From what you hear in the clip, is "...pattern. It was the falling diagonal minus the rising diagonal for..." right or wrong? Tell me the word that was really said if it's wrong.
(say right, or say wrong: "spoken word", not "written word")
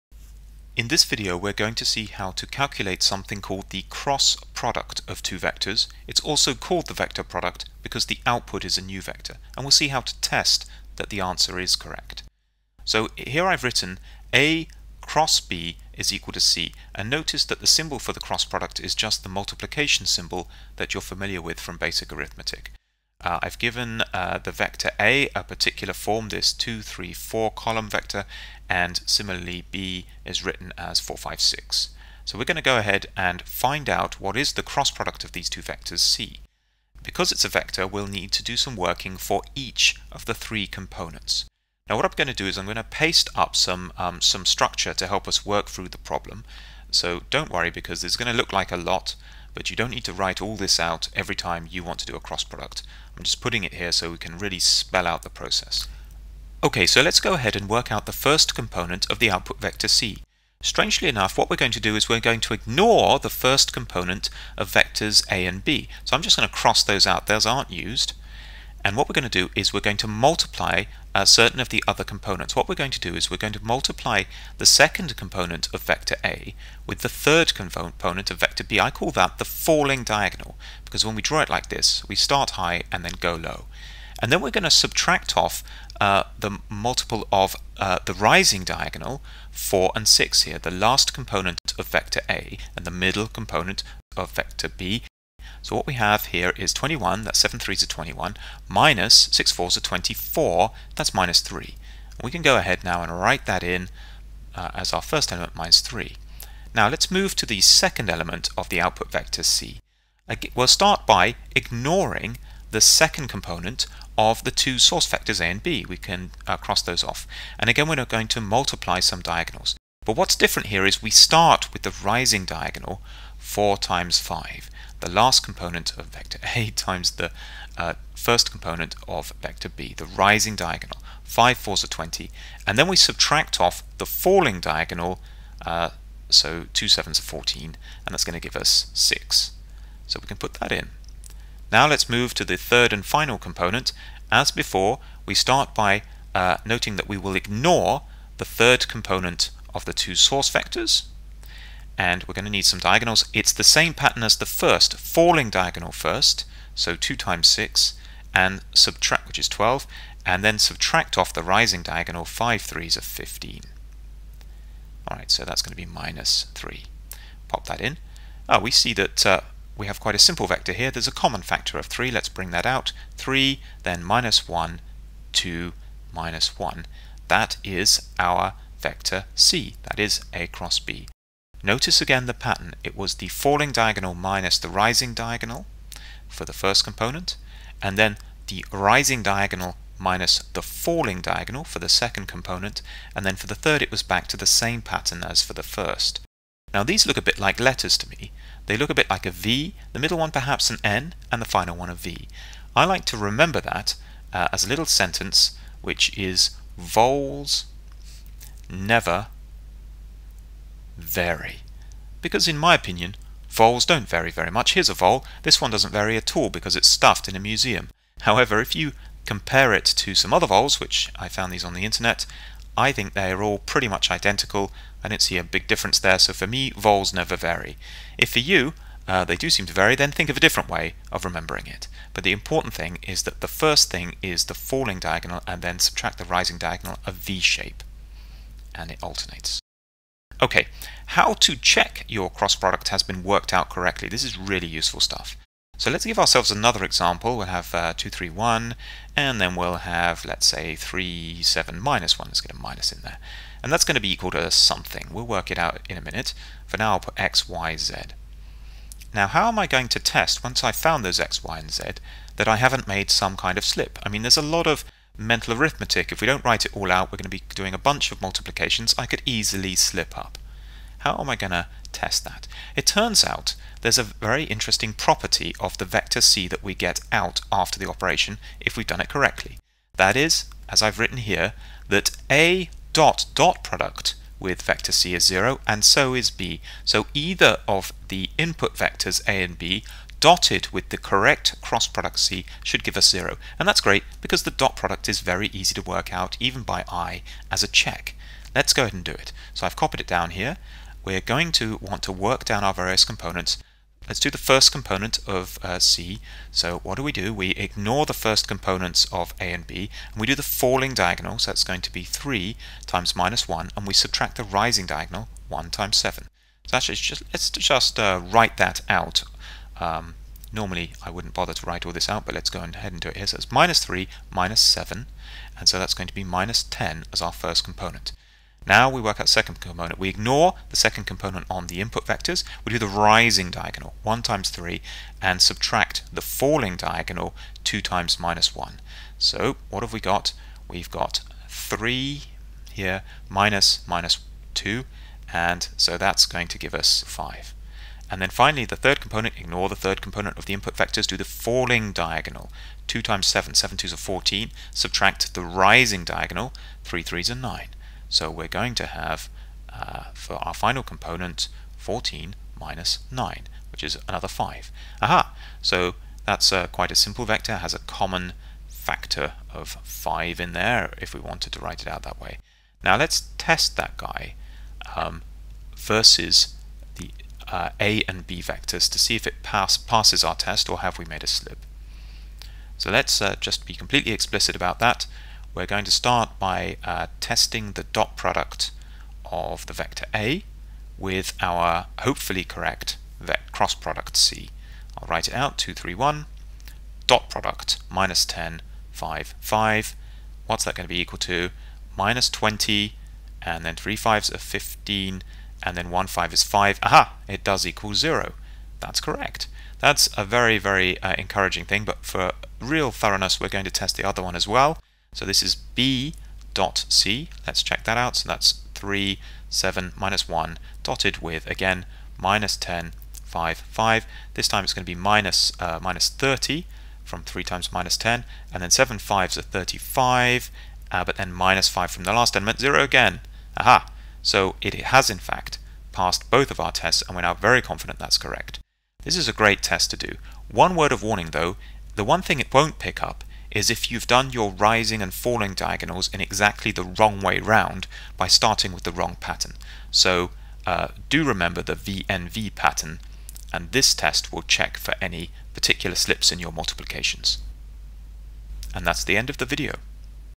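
right.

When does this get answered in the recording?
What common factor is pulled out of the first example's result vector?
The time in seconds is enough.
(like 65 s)
171 s.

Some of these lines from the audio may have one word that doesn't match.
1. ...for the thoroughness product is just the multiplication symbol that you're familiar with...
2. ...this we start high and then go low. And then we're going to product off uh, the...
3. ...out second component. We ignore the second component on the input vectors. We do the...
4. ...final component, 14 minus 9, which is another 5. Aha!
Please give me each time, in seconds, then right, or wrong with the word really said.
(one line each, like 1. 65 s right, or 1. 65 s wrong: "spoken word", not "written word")
1. 17 s wrong: "cross", not "thoroughness"
2. 81 s wrong: "subtract", not "product"
3. 329 s right
4. 360 s right.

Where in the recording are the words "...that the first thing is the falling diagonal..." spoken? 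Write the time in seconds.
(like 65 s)
233 s.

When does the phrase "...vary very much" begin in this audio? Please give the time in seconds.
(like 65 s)
214 s.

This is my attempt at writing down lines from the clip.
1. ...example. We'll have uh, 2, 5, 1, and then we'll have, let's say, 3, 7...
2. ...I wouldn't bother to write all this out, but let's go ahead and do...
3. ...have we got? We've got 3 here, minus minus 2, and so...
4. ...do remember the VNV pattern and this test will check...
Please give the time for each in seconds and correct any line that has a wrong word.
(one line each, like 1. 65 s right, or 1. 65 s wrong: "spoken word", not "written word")
1. 246 s wrong: "3", not "5"
2. 321 s right
3. 339 s right
4. 451 s right.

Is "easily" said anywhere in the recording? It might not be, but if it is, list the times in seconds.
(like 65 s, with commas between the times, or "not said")
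269 s.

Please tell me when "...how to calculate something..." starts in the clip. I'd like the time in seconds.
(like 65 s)
2 s.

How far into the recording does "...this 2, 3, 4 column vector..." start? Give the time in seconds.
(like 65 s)
26 s.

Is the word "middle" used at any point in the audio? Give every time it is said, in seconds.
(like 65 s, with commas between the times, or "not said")
92 s, 199 s.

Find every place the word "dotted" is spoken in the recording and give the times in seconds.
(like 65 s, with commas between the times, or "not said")
290 s, 420 s.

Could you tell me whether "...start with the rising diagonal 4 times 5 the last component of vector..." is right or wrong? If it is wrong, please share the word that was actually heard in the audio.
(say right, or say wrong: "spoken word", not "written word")
right.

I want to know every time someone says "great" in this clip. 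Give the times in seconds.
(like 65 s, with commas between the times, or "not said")
293 s, 439 s.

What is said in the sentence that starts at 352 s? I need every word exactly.
2 times 7, 7 twos are 14, subtract the rising diagonal, 3 threes are 9.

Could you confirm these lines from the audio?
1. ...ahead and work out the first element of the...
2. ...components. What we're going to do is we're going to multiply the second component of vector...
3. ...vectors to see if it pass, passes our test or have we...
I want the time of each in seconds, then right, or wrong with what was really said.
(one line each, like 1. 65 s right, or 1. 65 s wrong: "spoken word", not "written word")
1. 57 s wrong: "component", not "element"
2. 72 s right
3. 378 s right.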